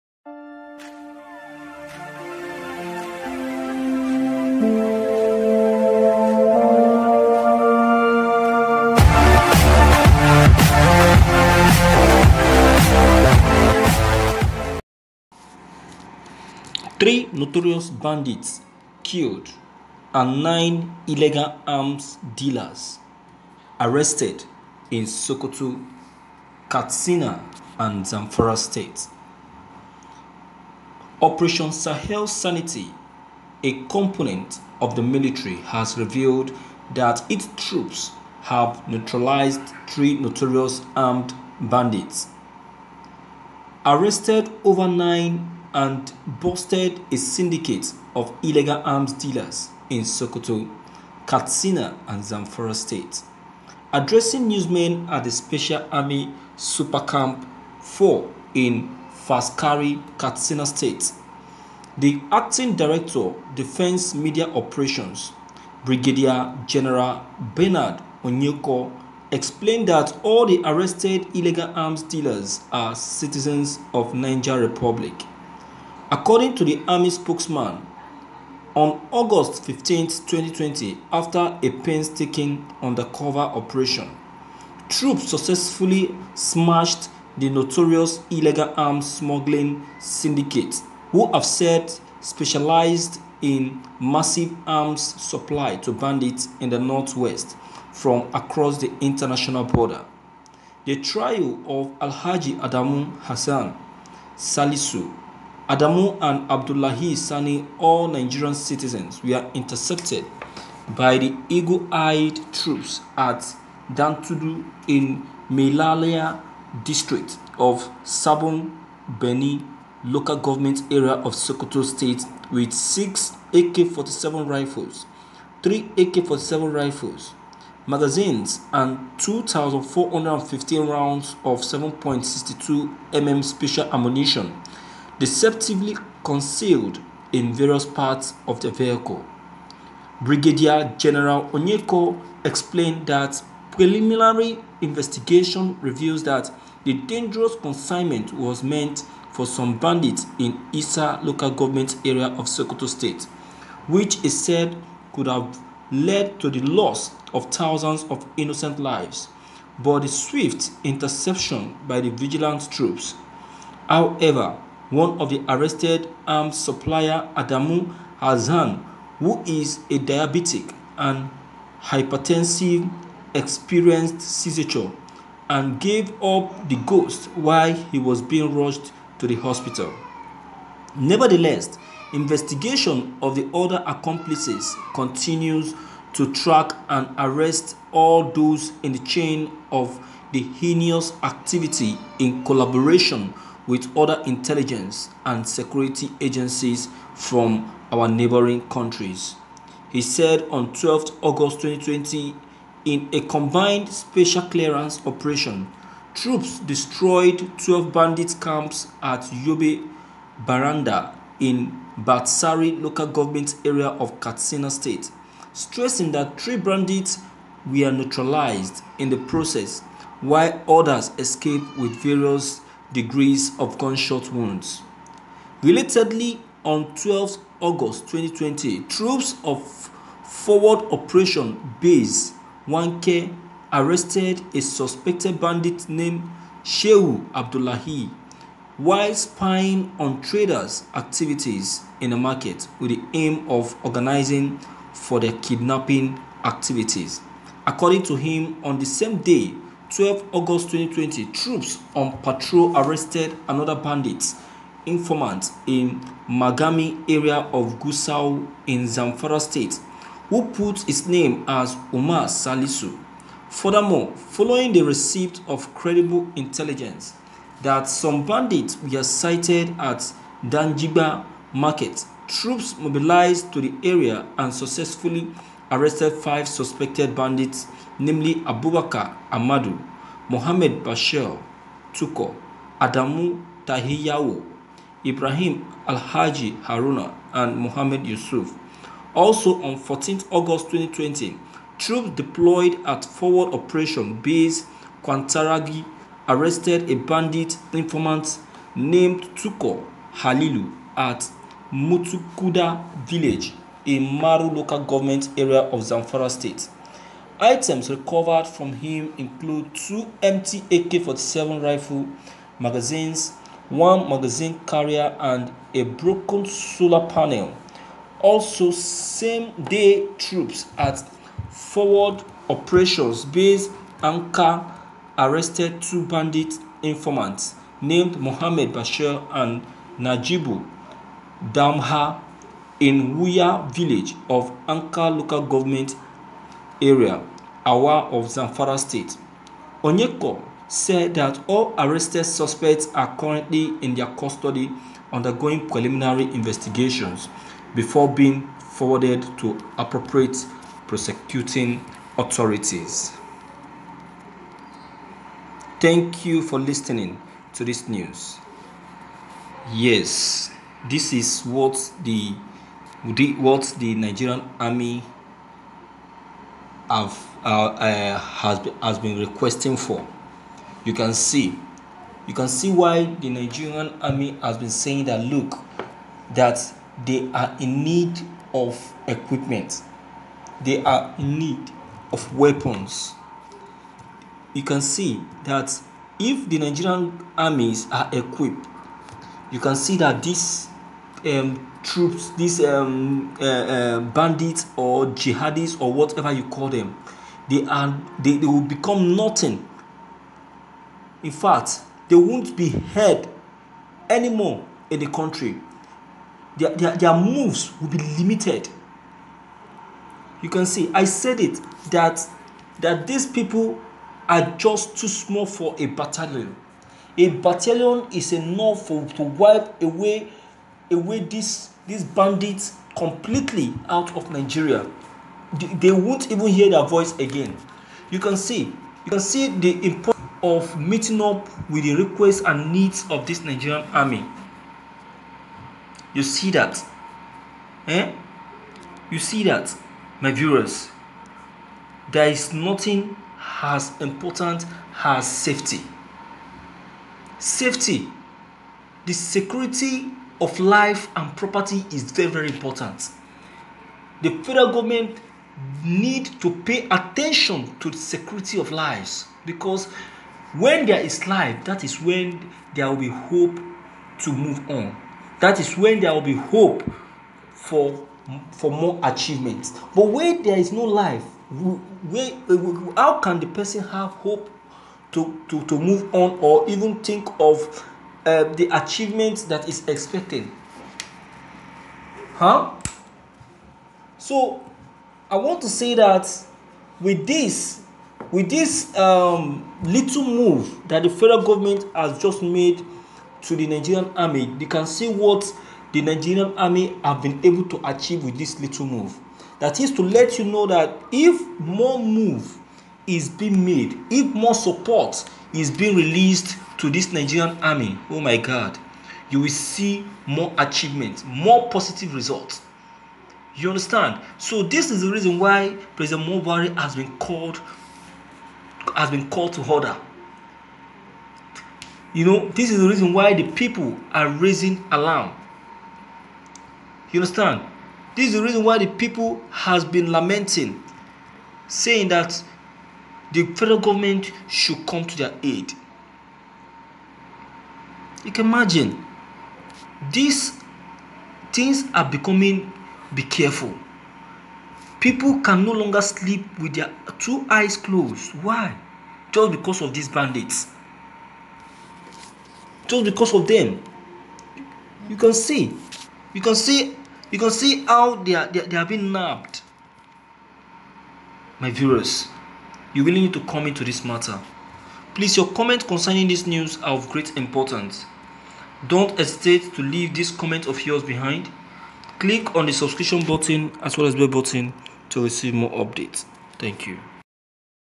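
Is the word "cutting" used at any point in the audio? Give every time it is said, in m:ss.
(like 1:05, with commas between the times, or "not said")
not said.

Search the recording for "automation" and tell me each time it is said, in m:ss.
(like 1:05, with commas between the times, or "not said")
not said.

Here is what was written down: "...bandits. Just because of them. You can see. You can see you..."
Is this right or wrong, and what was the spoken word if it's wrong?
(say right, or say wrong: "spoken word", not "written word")
right.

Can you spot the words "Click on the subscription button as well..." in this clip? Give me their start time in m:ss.
9:32.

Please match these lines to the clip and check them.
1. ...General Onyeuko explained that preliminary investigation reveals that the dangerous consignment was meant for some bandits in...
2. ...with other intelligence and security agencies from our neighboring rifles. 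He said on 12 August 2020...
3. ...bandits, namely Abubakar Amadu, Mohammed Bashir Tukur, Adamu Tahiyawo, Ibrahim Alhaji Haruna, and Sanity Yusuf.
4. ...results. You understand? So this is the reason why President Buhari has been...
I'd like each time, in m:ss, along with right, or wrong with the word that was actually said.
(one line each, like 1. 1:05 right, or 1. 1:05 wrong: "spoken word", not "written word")
1. 2:20 right
2. 3:13 wrong: "countries", not "rifles"
3. 4:37 wrong: "Mohammed", not "Sanity"
4. 8:32 right.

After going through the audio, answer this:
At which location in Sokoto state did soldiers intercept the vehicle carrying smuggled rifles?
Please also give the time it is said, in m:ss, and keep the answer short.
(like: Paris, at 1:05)
Dantudu, at 1:53.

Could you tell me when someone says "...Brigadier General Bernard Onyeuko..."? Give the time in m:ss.
1:05.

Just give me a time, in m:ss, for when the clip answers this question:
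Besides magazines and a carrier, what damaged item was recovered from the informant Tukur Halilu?
5:15.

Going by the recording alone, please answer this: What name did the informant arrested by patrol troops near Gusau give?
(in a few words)
Umar Salisu.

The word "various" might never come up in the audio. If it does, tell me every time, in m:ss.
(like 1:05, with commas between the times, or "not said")
2:17, 3:41.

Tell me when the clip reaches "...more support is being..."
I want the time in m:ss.
8:24.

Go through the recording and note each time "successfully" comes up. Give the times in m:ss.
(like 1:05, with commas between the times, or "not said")
1:25, 4:34.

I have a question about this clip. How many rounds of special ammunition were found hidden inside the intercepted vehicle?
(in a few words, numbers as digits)
2,415.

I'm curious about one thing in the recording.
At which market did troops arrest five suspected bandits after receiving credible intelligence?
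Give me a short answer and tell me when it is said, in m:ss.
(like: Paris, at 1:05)
Danjiba market, at 4:30.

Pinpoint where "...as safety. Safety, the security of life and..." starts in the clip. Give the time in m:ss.
7:25.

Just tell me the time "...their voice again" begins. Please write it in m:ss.
7:06.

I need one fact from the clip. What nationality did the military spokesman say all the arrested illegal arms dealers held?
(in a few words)
Niger Republic.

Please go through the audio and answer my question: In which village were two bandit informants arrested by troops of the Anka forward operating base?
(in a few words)
Wuya.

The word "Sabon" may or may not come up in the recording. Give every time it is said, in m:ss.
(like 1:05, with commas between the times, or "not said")
1:58.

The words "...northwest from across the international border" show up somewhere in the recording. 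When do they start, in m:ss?
1:36.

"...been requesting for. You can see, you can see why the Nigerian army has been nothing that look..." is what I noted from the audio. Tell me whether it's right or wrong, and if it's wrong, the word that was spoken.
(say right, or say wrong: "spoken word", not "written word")
wrong: "saying", not "nothing".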